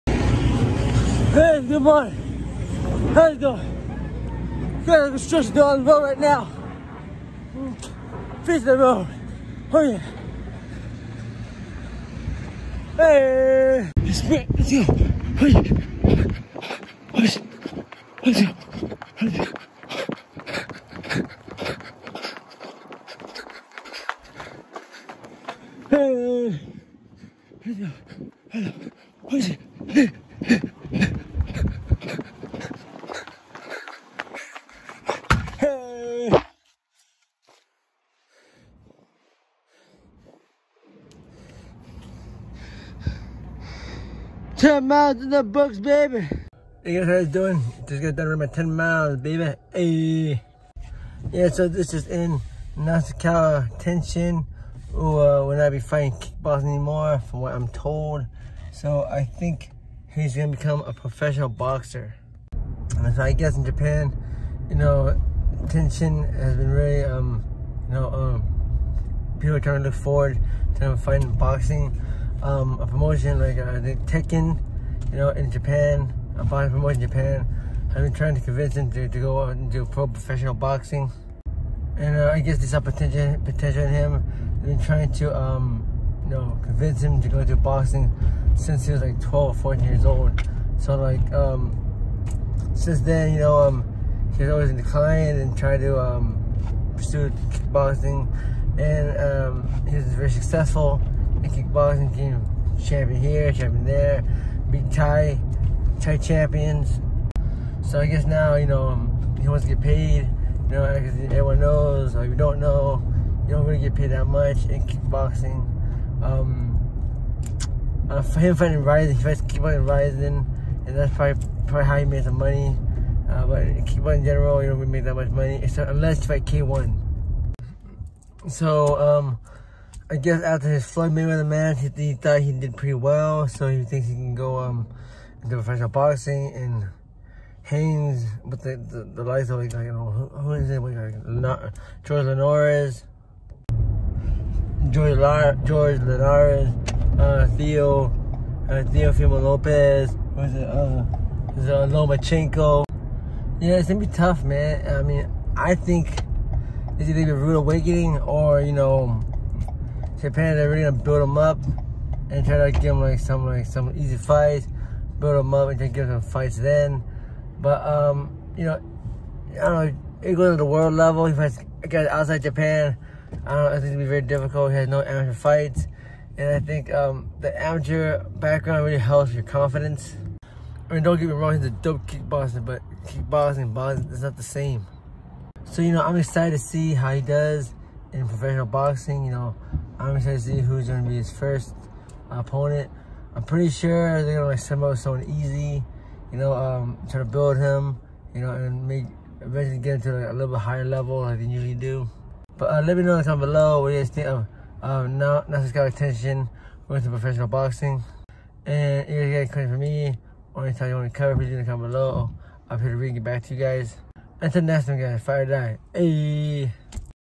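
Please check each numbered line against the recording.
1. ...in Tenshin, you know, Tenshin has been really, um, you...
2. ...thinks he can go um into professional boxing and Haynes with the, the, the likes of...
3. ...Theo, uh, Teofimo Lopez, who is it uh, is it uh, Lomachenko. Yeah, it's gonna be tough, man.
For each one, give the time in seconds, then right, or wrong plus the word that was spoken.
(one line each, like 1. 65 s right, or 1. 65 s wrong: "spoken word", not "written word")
1. 63 s wrong: "Japan", not "Tenshin"
2. 133 s right
3. 147 s right.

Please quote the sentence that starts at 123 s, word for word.
Uh, but kickboxing in general, you don't really make that much money, except unless you fight K1.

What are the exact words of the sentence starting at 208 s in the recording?
And if you guys got for me or anytime you want to cover, please in the comment below.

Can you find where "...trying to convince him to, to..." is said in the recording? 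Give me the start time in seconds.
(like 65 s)
78 s.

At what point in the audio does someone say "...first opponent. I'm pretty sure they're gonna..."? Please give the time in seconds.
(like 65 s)
191 s.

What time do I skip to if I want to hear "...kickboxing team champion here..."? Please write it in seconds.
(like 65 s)
101 s.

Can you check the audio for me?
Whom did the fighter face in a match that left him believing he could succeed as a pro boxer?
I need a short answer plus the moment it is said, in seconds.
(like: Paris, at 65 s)
Floyd Mayweather, at 130 s.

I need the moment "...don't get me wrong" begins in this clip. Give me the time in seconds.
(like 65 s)
181 s.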